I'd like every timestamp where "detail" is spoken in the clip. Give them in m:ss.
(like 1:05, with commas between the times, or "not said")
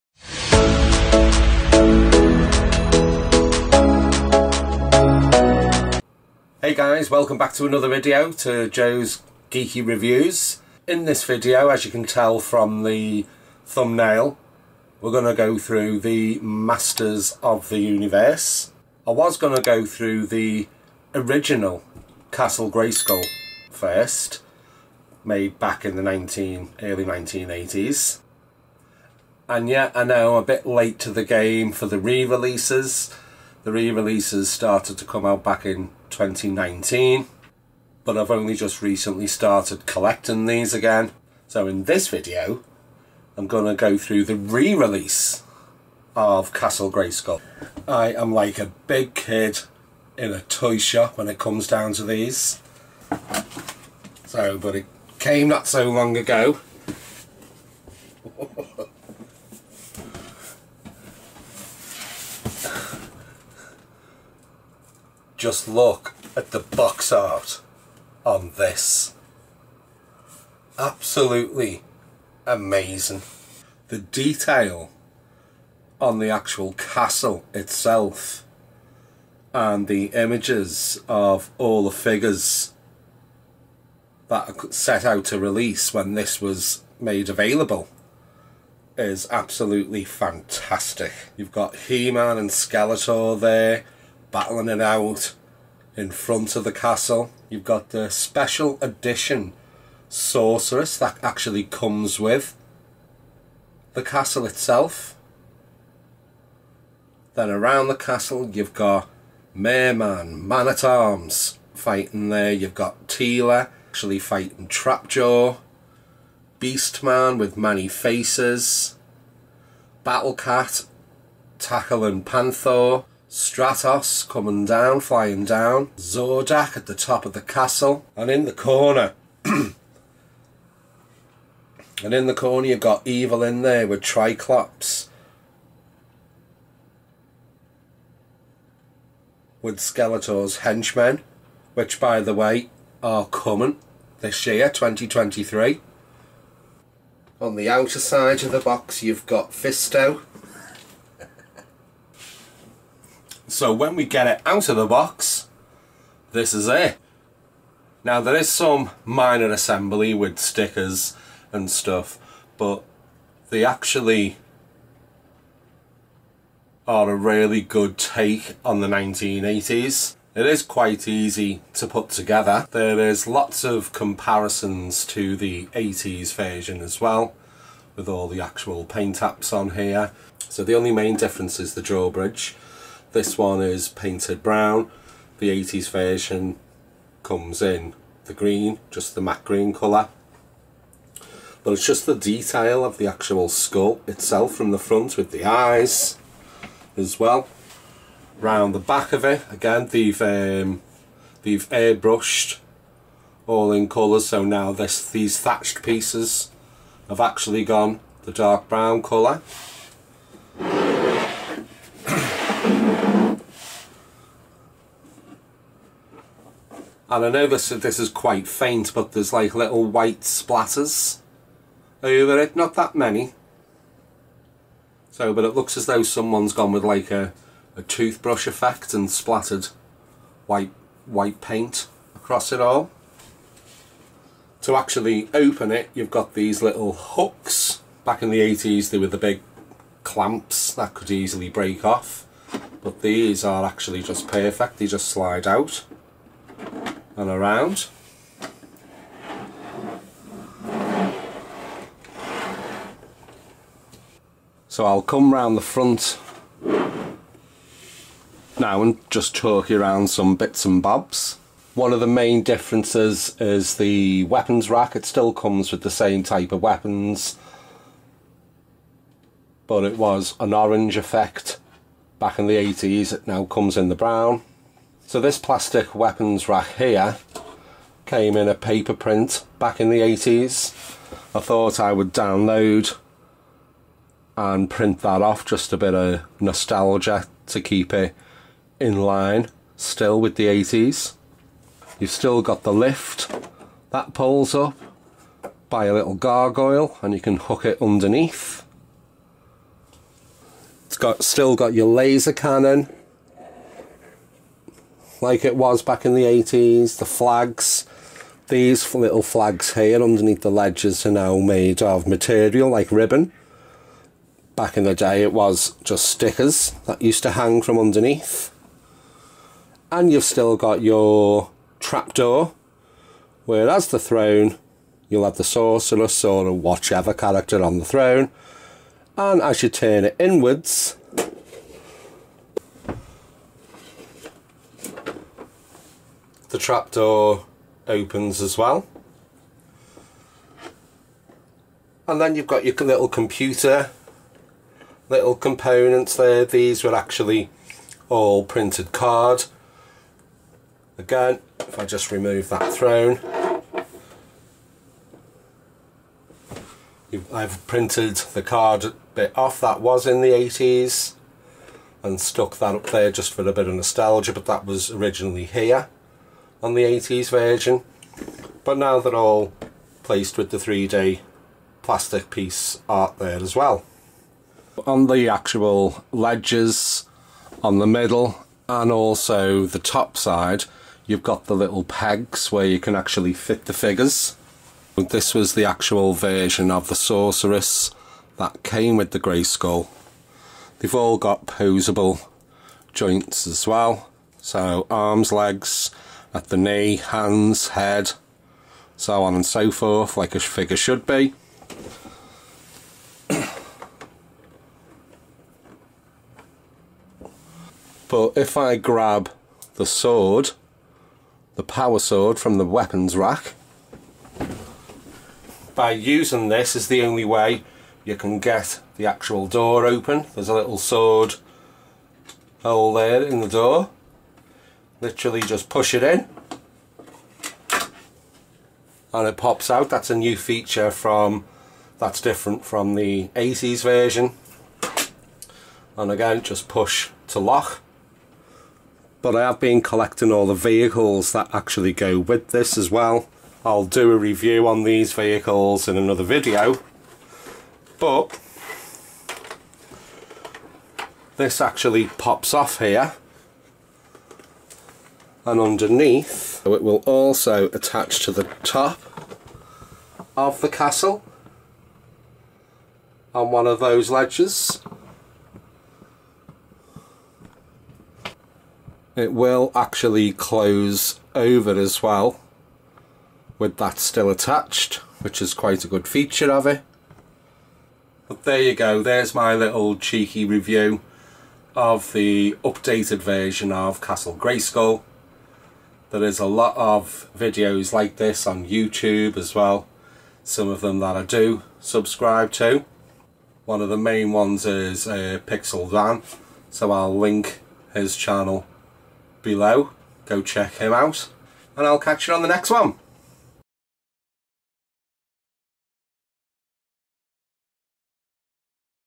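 1:13, 3:12.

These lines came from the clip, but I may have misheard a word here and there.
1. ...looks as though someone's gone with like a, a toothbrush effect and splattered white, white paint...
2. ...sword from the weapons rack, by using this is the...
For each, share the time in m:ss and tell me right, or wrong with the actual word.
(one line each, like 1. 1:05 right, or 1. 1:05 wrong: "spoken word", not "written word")
1. 3:45 right
2. 6:51 right.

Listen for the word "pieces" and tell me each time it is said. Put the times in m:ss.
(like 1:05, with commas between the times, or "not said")
3:25, 6:12.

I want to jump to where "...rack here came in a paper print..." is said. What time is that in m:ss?
4:36.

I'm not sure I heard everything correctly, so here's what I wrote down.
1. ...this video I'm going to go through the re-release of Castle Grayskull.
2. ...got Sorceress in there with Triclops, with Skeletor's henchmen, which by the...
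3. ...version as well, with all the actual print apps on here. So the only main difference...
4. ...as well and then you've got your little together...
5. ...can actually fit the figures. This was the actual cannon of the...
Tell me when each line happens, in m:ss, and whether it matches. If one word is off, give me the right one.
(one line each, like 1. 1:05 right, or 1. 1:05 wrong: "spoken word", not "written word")
1. 0:41 right
2. 2:12 wrong: "Evil", not "Sorceress"
3. 2:56 wrong: "paint", not "print"
4. 5:38 wrong: "computer", not "together"
5. 6:22 wrong: "version", not "cannon".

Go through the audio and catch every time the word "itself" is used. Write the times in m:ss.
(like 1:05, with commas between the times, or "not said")
1:17, 1:44, 3:14.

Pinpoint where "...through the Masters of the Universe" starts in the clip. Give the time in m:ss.
0:15.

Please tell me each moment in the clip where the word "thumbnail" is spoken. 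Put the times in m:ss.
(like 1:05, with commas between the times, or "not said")
0:13.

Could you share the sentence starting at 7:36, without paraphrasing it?
it will also attach to the top of the castle on one of those ledges.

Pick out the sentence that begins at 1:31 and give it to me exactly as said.
You've got He-Man and Skeletor there battling it out in front of the castle.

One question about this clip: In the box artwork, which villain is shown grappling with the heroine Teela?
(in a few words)
Trapjaw.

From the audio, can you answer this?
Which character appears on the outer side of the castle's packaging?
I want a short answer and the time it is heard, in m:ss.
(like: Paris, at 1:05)
Fisto, at 2:29.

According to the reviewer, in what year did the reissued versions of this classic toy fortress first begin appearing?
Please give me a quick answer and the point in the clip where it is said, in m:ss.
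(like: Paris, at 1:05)
2019, at 0:36.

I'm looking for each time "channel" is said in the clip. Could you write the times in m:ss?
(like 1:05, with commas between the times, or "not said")
8:18.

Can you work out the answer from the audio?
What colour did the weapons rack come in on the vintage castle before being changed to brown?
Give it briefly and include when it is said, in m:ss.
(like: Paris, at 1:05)
Orange, at 4:30.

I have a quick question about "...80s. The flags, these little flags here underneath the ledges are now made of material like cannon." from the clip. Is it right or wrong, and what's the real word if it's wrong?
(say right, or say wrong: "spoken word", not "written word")
wrong: "ribbon", not "cannon".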